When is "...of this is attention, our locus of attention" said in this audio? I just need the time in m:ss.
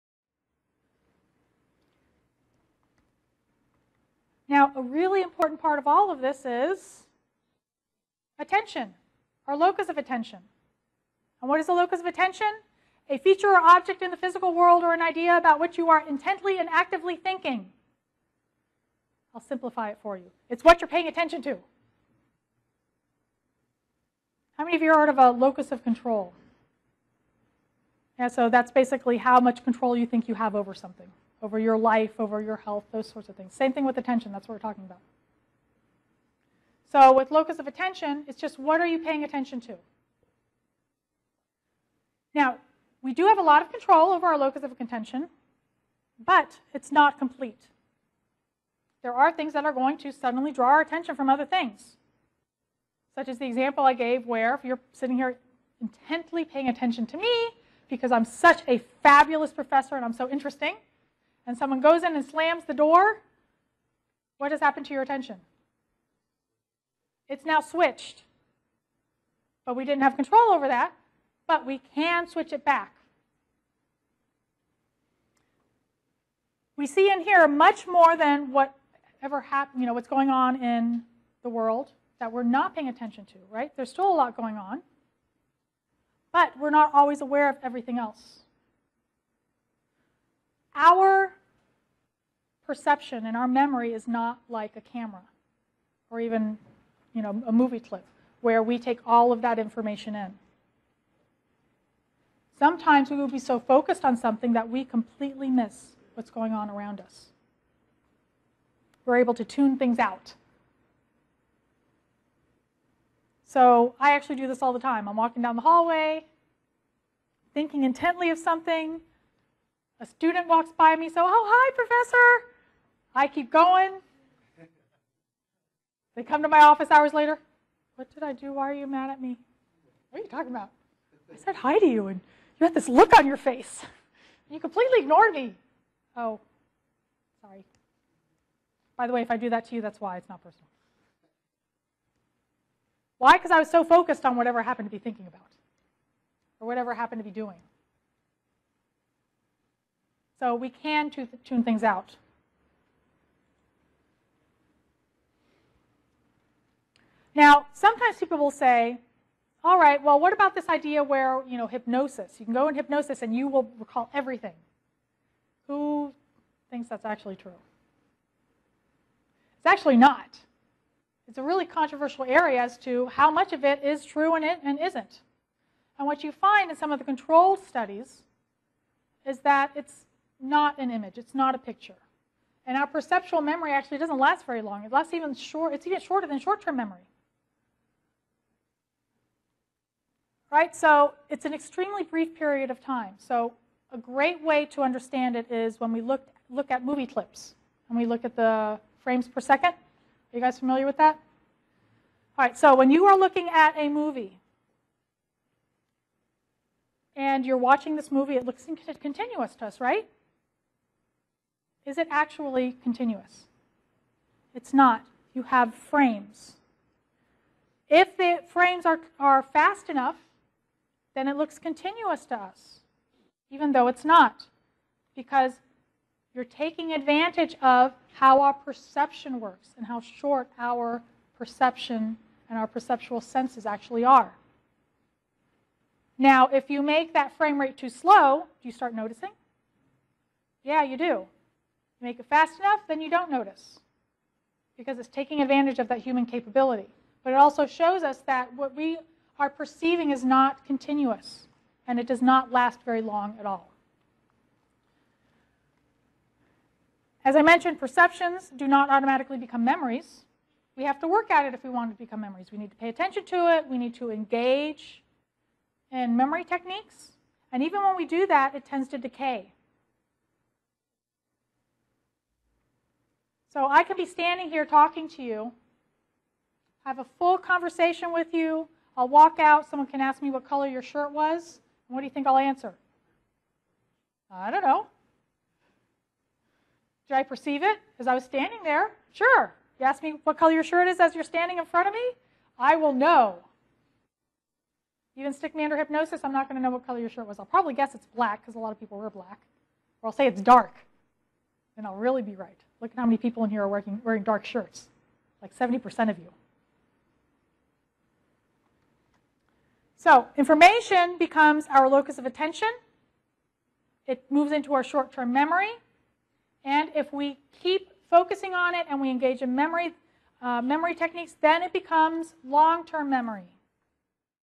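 0:06.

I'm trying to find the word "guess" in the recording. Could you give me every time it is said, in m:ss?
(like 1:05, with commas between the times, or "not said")
4:57.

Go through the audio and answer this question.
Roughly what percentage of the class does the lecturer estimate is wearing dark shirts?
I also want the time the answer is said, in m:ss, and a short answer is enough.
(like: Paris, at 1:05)
70%, at 5:05.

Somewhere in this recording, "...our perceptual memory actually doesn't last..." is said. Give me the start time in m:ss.
3:02.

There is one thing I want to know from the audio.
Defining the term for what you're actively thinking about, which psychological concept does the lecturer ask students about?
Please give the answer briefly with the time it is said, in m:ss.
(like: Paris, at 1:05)
locus of control, at 0:25.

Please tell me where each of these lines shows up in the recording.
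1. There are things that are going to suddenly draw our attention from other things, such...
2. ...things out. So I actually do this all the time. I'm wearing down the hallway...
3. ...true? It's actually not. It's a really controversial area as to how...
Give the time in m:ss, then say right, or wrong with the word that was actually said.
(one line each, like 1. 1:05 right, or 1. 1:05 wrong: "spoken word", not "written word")
1. 0:49 right
2. 1:49 wrong: "walking", not "wearing"
3. 2:47 right.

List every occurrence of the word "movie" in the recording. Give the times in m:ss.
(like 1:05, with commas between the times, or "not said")
1:37, 3:16, 3:23, 3:28.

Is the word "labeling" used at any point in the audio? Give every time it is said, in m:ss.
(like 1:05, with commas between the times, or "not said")
not said.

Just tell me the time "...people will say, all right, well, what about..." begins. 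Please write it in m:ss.
2:38.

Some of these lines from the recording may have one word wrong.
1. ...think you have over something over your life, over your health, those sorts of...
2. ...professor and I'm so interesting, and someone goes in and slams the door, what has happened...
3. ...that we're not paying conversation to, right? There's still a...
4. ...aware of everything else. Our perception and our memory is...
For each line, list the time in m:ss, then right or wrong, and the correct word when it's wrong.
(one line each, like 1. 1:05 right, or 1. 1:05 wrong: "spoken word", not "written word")
1. 0:30 right
2. 0:59 right
3. 1:22 wrong: "attention", not "conversation"
4. 1:27 right.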